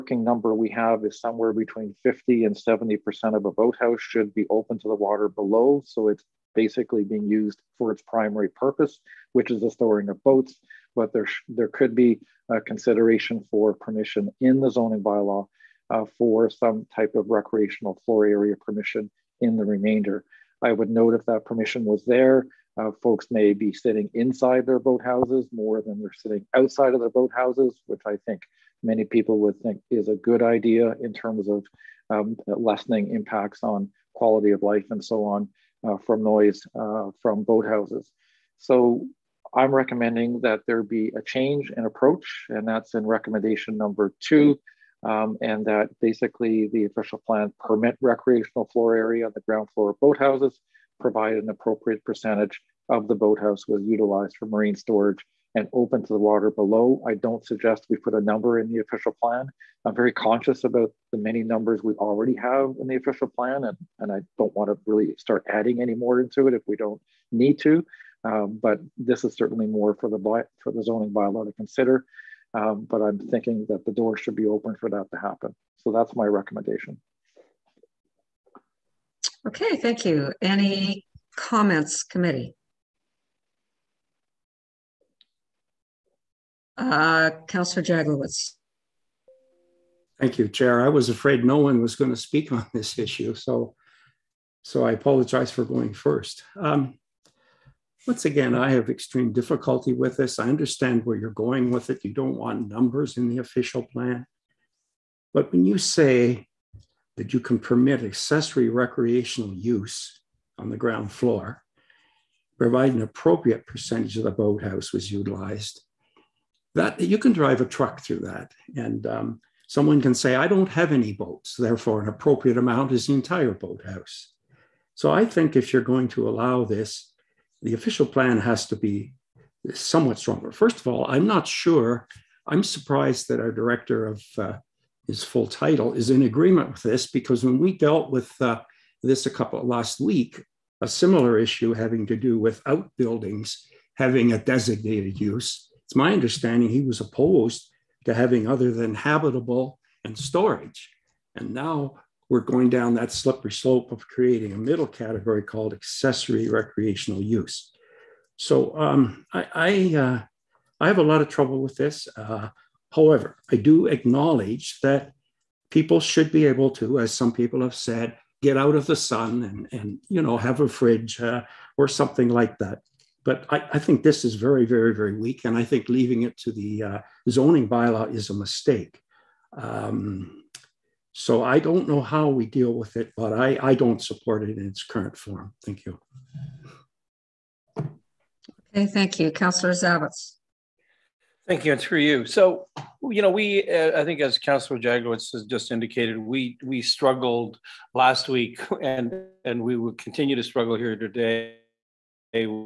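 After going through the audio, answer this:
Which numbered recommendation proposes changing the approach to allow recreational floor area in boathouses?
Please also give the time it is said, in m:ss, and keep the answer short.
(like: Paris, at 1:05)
2, at 0:43.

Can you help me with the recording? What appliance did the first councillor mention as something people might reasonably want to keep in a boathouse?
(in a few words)
fridge.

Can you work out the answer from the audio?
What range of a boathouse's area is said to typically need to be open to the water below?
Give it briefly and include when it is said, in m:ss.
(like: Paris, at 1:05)
50 to 70%, at 0:01.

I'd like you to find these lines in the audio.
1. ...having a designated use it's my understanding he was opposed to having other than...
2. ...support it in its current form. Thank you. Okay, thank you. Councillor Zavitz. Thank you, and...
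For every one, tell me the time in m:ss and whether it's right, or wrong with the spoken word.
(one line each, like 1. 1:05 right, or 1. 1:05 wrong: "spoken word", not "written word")
1. 2:23 right
2. 3:04 right.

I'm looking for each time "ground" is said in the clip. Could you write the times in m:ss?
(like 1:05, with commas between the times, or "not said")
0:49, 1:50.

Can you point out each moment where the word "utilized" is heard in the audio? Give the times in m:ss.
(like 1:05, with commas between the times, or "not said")
0:53, 1:55.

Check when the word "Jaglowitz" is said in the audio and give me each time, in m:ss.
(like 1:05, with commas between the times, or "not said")
1:27, 3:14.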